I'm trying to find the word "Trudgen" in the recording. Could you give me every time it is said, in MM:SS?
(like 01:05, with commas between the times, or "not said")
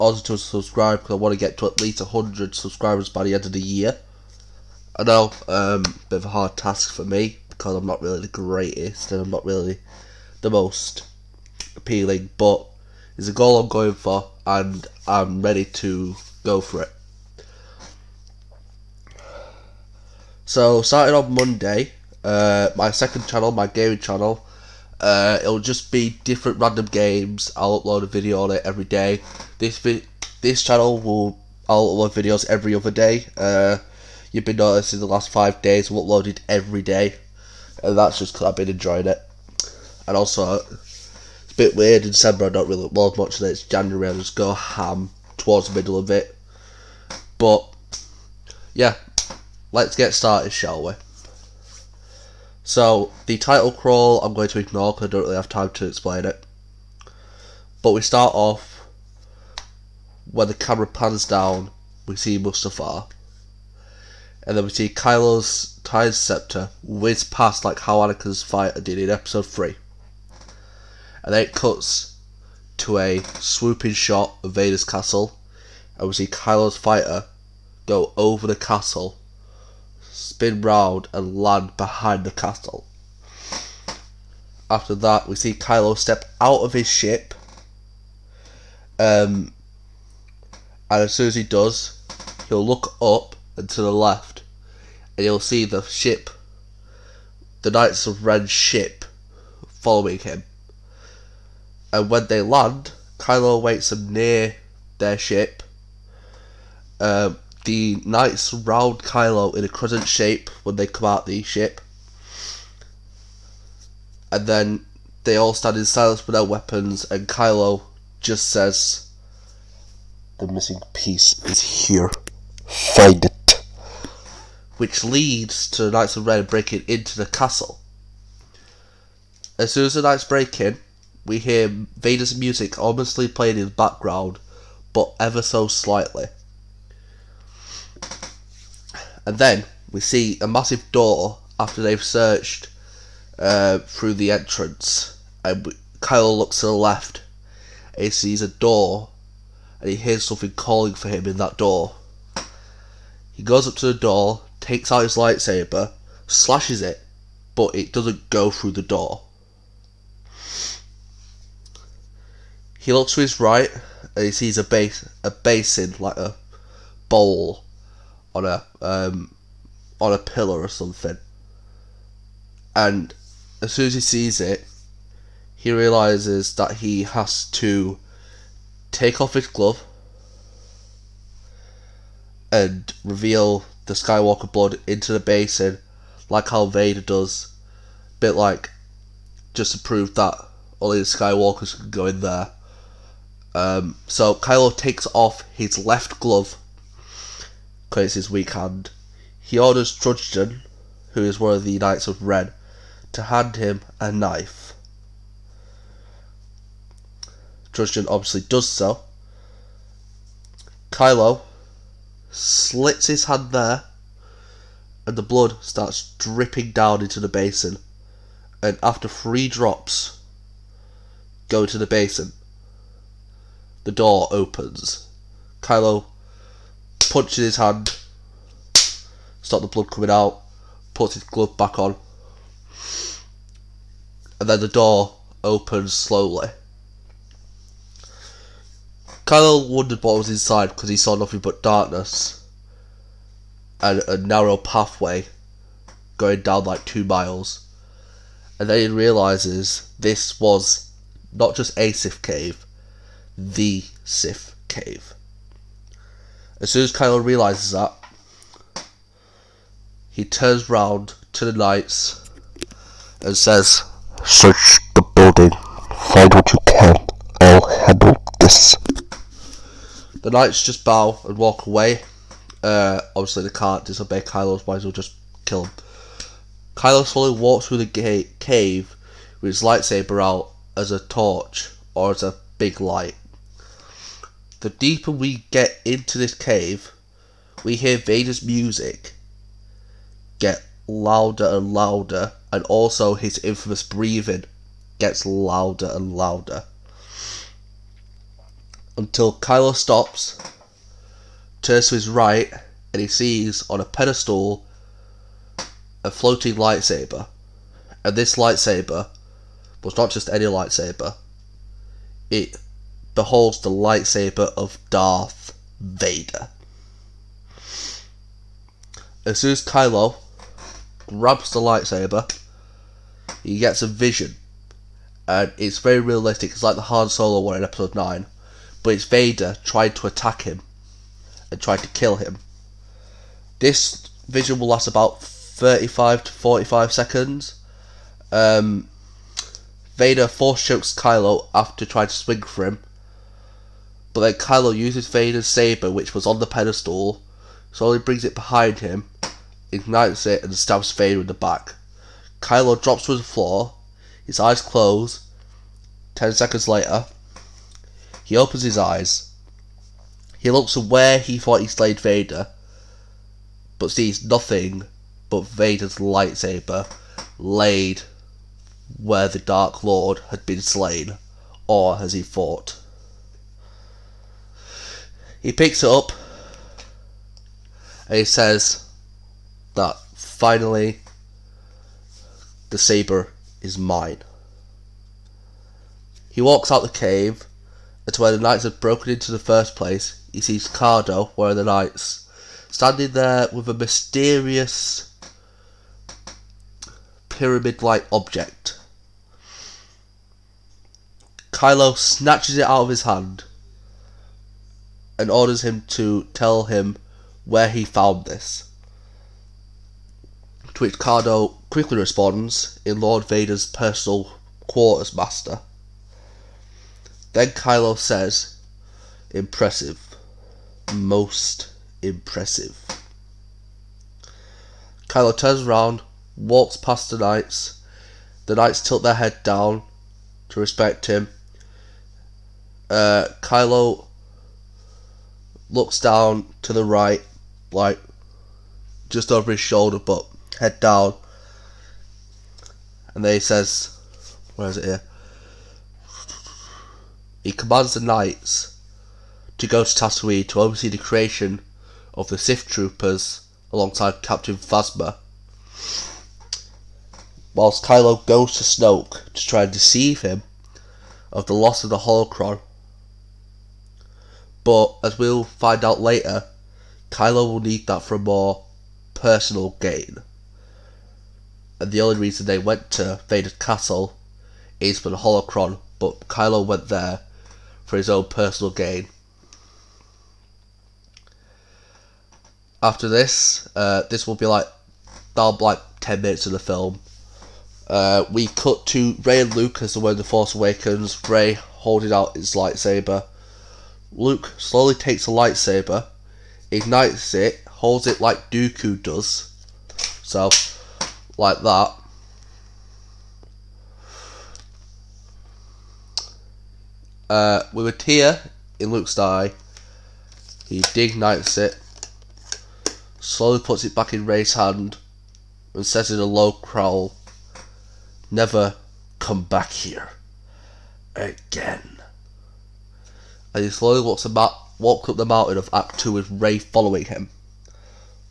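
03:19, 03:27.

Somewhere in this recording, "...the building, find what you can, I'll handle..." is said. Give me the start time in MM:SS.
04:24.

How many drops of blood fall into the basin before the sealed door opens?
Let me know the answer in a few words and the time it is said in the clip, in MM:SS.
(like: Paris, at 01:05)
3, at 03:39.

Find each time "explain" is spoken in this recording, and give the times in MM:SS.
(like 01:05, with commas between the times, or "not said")
00:55.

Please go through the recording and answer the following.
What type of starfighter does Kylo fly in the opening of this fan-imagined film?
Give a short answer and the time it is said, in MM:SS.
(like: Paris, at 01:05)
TIE Silencer, at 01:05.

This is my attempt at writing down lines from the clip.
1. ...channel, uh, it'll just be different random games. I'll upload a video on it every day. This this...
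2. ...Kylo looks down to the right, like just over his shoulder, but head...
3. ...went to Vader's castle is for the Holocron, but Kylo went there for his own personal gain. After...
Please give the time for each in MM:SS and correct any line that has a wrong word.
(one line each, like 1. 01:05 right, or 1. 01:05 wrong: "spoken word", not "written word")
1. 00:23 right
2. 07:13 right
3. 07:52 right.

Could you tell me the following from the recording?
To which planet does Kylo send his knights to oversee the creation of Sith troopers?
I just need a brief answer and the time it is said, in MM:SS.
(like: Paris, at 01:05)
Tatooine, at 07:29.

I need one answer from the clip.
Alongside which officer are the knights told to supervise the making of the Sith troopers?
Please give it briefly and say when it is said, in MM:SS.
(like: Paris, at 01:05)
Captain Phasma, at 07:34.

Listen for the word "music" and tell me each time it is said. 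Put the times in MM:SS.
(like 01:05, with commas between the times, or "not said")
02:12, 04:48.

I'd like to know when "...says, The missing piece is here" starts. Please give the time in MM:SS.
01:58.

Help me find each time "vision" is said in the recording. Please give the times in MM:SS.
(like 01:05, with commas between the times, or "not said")
05:23, 05:34.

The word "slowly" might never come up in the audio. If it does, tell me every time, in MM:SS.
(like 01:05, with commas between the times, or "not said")
03:55, 04:37, 05:47, 08:14, 08:33, 08:43.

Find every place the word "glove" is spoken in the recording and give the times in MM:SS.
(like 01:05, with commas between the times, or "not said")
02:59, 03:16, 03:51.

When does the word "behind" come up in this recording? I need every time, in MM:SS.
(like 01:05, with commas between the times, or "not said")
01:21, 05:48.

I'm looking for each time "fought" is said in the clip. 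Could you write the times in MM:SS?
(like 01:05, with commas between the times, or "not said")
06:12.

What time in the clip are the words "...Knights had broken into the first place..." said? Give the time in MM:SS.
06:28.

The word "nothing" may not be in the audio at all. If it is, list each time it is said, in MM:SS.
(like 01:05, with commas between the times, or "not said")
04:01, 06:04.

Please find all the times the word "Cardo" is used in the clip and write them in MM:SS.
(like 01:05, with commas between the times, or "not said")
06:30, 06:50.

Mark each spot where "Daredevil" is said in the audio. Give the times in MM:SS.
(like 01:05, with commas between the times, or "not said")
not said.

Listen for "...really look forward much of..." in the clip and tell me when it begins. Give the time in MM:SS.
00:42.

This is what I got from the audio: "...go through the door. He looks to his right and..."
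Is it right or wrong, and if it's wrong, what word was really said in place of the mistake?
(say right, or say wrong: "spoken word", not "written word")
right.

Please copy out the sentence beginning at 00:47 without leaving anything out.
But, yeah, let's get started, shall we?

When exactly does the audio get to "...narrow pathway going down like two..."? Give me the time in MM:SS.
04:04.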